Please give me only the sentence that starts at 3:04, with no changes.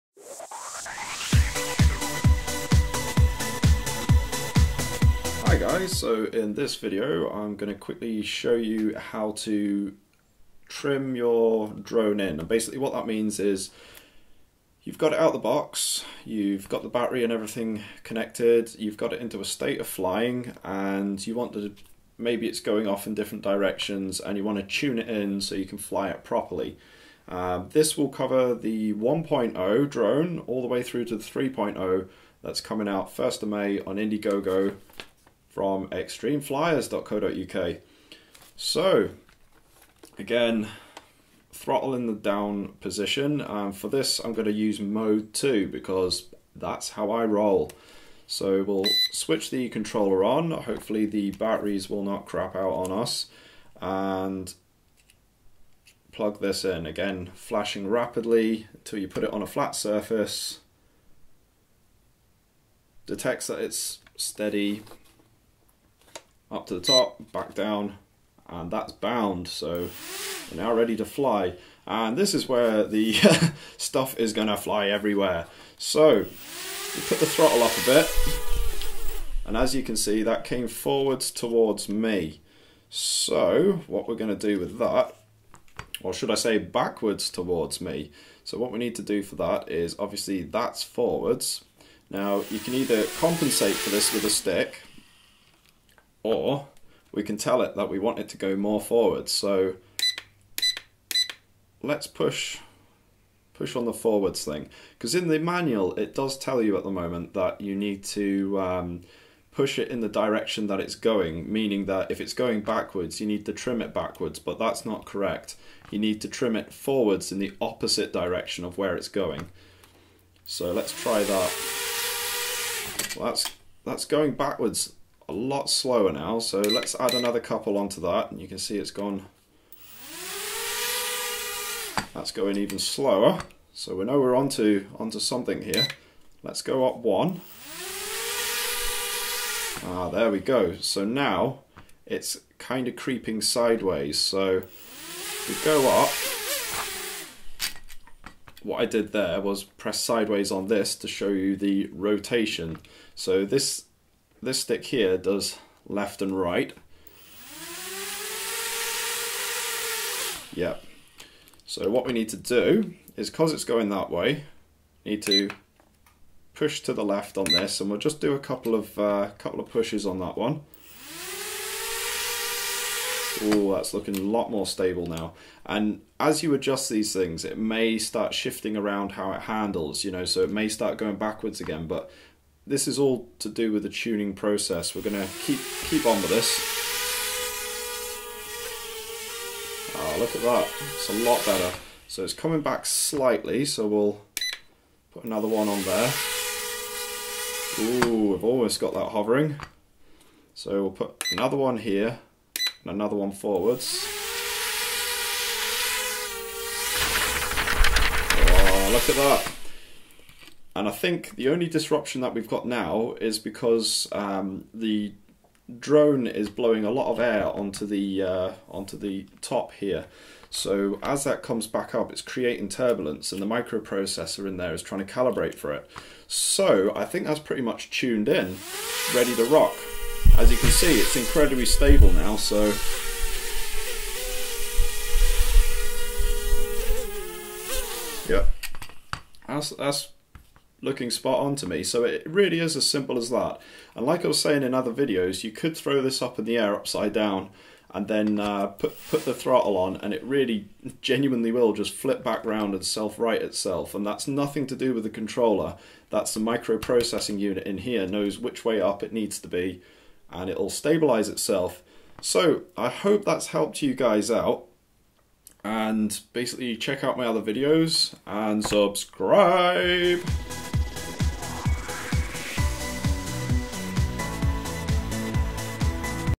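We're gonna keep keep on with this.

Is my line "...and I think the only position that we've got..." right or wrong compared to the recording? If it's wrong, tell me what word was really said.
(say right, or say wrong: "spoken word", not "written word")
wrong: "disruption", not "position".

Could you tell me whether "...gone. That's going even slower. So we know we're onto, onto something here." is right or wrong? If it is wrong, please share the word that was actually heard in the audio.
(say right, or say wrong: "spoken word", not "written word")
right.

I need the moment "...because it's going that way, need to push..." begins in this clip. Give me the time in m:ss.
2:43.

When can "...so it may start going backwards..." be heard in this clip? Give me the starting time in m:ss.
3:00.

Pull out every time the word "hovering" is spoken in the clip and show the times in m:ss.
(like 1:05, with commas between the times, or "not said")
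3:19.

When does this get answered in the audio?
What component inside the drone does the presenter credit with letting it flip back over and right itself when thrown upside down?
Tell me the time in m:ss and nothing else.
4:16.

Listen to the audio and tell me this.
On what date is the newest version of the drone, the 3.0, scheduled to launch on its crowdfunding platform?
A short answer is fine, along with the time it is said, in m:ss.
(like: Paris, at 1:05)
1st of May, at 0:33.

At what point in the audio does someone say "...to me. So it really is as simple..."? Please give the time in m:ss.
4:01.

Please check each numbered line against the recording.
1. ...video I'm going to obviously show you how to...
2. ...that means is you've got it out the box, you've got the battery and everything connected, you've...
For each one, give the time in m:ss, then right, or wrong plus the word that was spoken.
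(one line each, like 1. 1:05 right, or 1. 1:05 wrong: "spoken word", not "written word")
1. 0:06 wrong: "quickly", not "obviously"
2. 0:12 right.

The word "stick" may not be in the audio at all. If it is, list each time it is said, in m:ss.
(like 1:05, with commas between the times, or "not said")
1:34, 2:34.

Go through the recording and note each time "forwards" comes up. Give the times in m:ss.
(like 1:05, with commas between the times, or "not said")
1:20, 1:30, 1:38, 1:43, 1:56, 3:23.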